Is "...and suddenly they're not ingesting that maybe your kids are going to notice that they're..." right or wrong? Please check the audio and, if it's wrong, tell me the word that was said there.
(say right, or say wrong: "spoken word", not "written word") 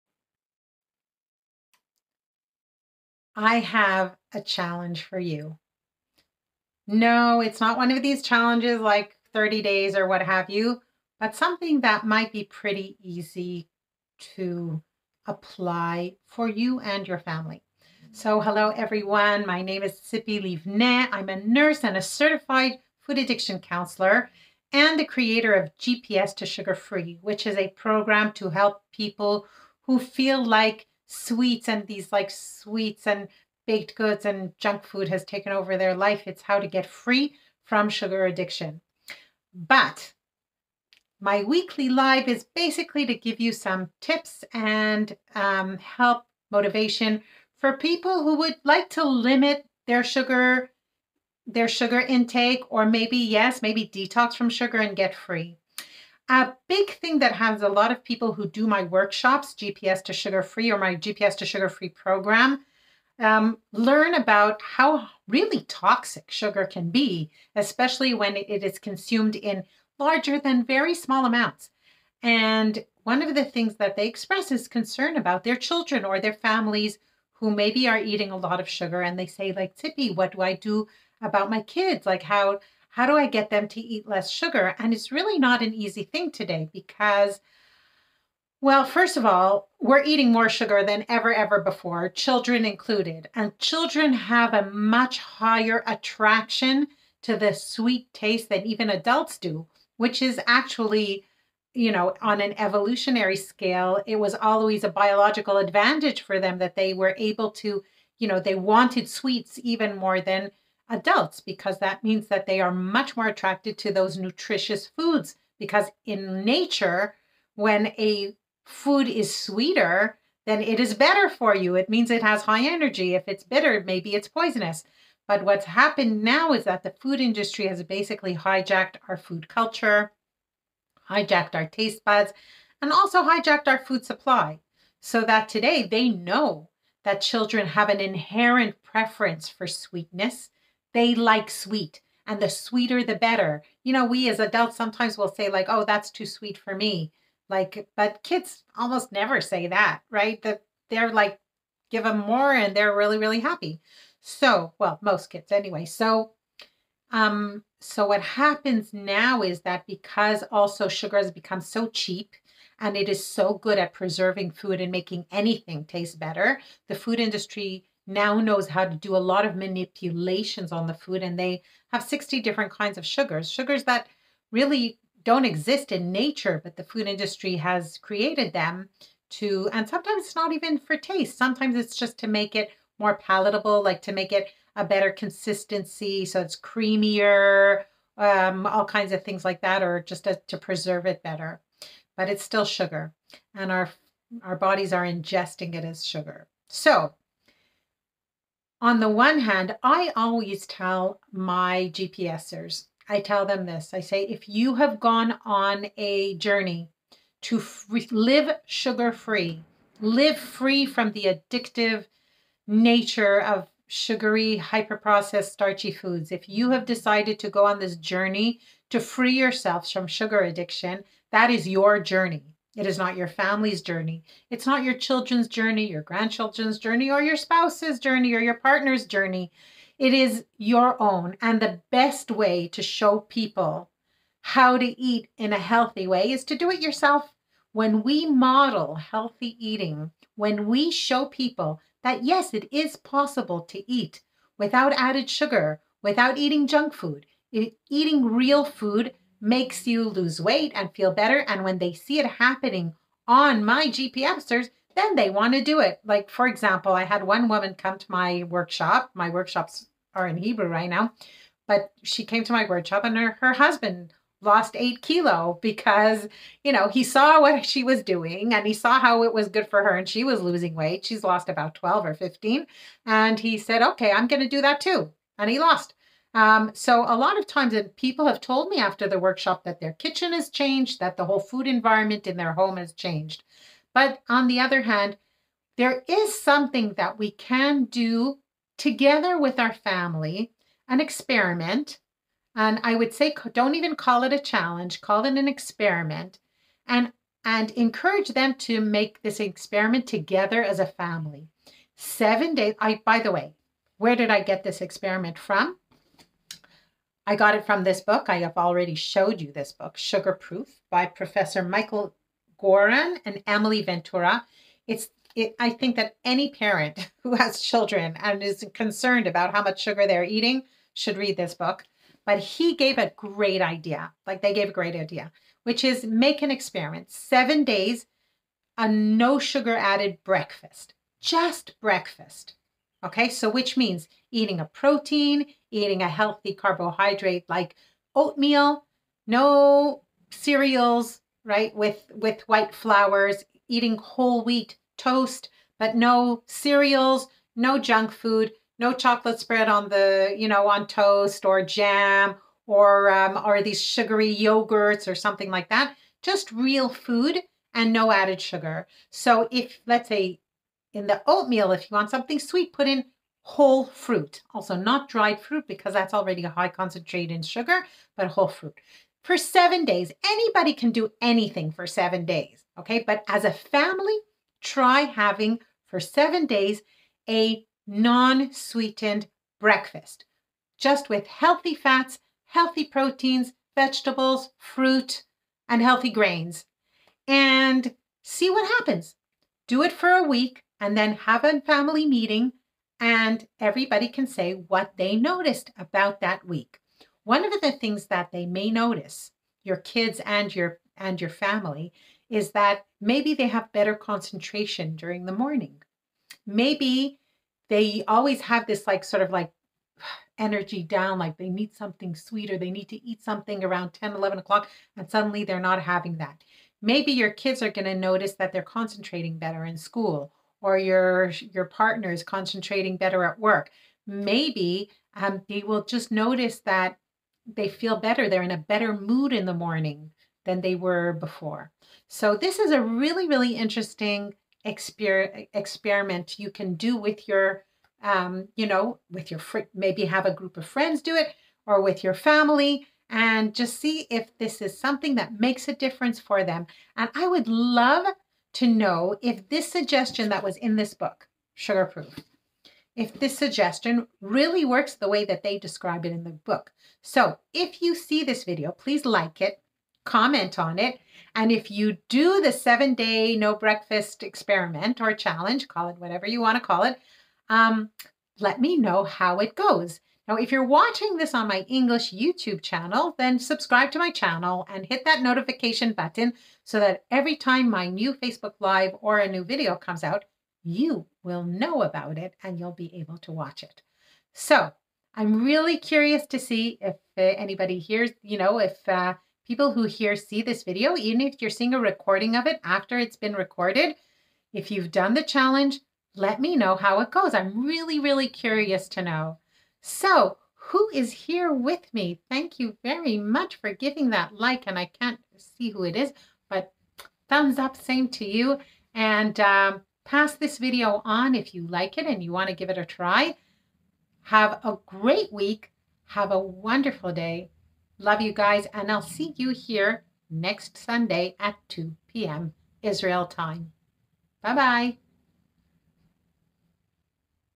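wrong: "having", not "ingesting".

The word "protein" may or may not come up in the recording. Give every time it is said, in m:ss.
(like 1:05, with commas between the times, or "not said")
5:34, 6:22.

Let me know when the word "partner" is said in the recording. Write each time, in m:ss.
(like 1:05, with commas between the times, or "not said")
3:48, 7:01.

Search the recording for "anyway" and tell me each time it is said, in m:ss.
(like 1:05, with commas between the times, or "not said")
2:35.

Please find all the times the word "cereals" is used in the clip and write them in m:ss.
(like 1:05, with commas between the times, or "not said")
5:40, 5:46.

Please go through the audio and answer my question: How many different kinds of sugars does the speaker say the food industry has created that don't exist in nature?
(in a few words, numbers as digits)
60.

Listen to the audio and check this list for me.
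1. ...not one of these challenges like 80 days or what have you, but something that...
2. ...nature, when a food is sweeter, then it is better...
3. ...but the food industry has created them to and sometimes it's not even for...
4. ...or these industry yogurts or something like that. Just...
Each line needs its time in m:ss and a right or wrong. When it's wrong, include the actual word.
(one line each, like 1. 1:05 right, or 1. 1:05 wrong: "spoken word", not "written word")
1. 0:07 wrong: "30", not "80"
2. 1:56 right
3. 2:56 right
4. 5:53 wrong: "sugary", not "industry".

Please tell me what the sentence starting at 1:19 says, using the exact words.
And they say, like, Tippy, what do I do about my kids?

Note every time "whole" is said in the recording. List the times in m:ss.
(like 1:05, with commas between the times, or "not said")
4:41, 5:43, 6:03, 6:08.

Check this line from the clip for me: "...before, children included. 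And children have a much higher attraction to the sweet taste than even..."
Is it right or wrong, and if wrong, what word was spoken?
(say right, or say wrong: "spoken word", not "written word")
right.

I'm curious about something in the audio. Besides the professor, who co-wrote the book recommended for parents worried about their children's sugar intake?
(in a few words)
Emily Ventura.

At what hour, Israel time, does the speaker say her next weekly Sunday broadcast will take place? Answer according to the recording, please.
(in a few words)
2 p.m.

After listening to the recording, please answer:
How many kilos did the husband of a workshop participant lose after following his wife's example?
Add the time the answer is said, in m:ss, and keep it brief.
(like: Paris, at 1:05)
8, at 4:24.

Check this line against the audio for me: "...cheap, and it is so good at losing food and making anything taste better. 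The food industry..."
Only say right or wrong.
wrong.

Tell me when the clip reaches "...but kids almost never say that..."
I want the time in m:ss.
2:27.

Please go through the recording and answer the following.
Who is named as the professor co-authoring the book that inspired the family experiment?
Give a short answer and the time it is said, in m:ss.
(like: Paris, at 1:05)
Michael Goran, at 5:11.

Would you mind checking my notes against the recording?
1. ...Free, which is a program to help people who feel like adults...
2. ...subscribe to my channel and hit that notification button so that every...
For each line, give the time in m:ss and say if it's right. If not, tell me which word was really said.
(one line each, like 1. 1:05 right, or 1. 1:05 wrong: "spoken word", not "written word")
1. 0:26 wrong: "sweets", not "adults"
2. 7:53 right.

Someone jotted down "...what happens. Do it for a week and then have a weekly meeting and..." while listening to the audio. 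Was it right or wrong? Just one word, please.
wrong.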